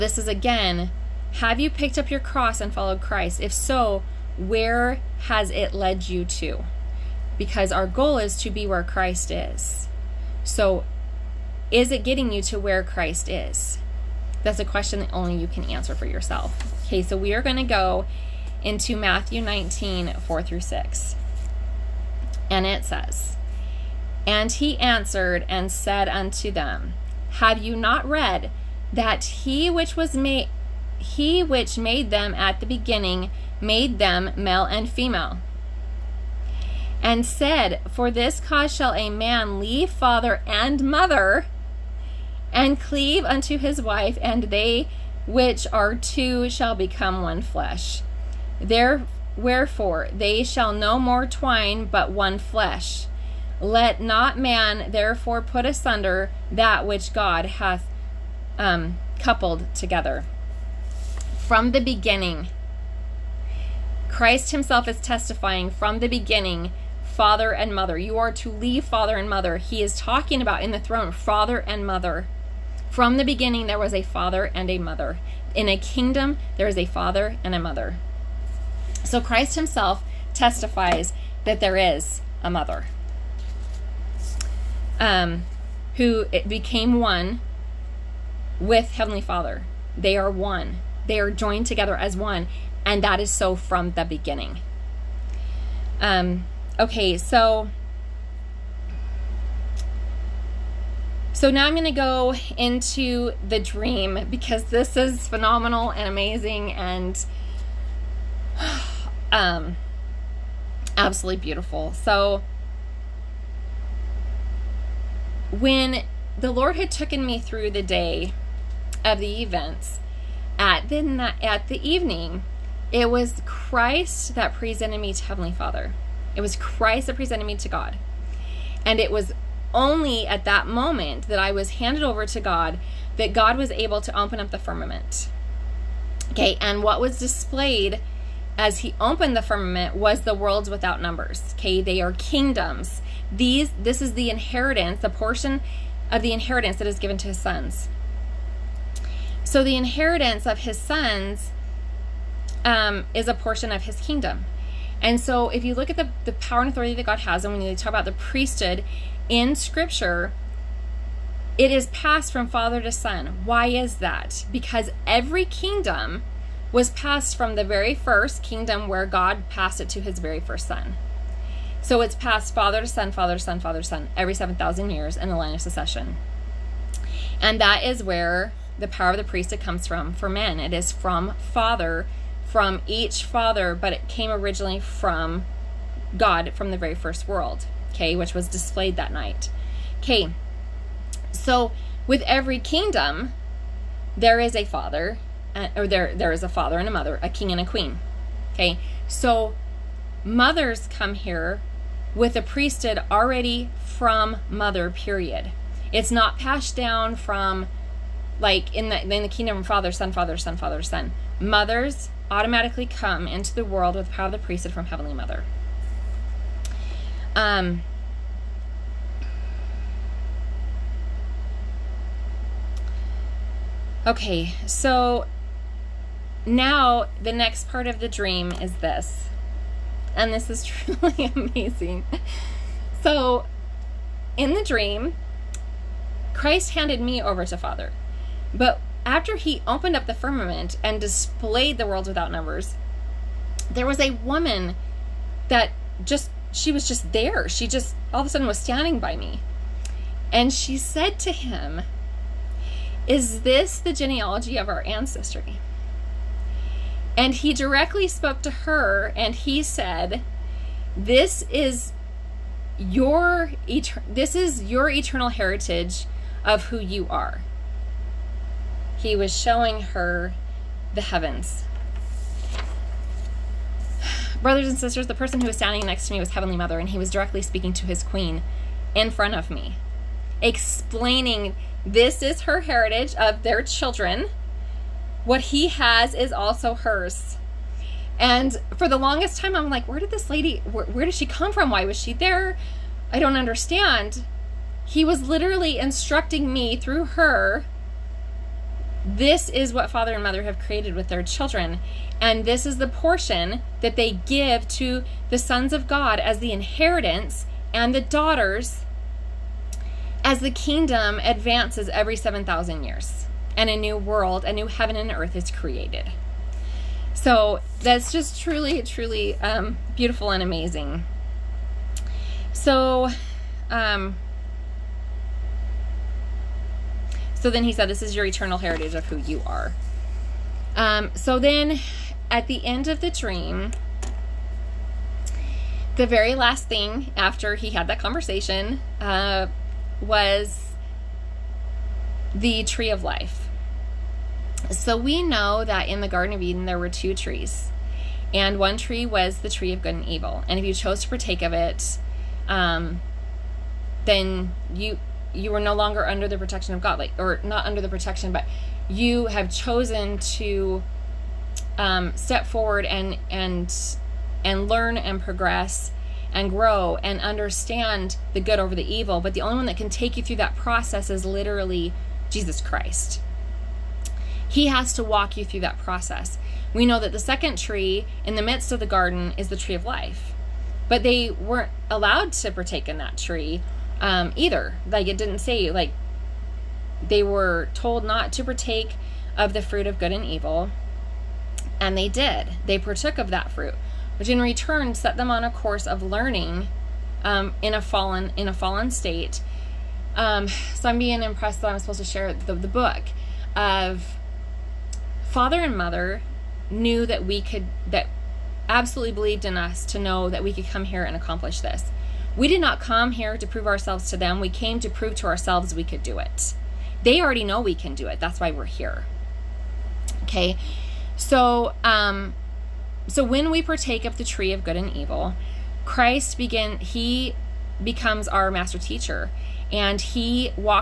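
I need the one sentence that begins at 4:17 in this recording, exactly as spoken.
And he directly spoke to her and he said, This is your this is your eternal heritage of who you are.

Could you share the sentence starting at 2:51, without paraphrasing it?
So it's passed father to son, father to son, father to son every 7,000 years in the line of succession.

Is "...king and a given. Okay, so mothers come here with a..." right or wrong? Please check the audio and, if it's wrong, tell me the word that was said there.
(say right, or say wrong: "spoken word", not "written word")
wrong: "queen", not "given".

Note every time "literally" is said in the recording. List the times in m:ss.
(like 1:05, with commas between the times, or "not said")
4:55, 6:11.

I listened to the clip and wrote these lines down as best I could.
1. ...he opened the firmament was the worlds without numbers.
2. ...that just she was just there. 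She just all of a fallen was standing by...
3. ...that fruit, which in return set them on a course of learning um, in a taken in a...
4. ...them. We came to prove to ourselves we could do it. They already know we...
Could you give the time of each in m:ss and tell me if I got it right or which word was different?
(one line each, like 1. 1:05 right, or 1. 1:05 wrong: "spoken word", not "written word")
1. 2:18 right
2. 4:05 wrong: "sudden", not "fallen"
3. 6:33 wrong: "fallen", not "taken"
4. 6:54 right.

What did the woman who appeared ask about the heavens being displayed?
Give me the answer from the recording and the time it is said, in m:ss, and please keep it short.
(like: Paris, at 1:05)
Is this the genealogy of our ancestry?, at 4:13.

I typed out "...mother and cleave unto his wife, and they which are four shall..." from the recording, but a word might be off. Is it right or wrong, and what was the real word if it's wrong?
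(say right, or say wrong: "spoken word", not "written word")
wrong: "two", not "four".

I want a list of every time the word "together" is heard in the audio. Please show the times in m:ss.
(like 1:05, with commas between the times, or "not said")
0:59, 1:31.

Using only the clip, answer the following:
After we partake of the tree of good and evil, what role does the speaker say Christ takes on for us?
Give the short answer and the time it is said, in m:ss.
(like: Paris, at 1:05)
Master teacher, at 7:08.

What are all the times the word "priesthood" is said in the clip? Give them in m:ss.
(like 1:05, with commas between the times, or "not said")
2:38, 2:59, 3:22, 3:34.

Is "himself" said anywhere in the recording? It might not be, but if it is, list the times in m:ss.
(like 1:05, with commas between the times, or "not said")
1:04, 1:19.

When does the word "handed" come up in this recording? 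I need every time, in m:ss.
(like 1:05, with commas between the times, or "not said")
2:11, 3:56.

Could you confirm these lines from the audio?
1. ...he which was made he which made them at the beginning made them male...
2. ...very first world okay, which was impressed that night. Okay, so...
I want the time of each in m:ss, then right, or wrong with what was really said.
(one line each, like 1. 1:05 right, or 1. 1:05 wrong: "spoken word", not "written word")
1. 0:29 right
2. 3:06 wrong: "displayed", not "impressed".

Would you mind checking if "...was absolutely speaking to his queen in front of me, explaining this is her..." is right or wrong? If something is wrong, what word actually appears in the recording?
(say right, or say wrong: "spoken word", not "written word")
wrong: "directly", not "absolutely".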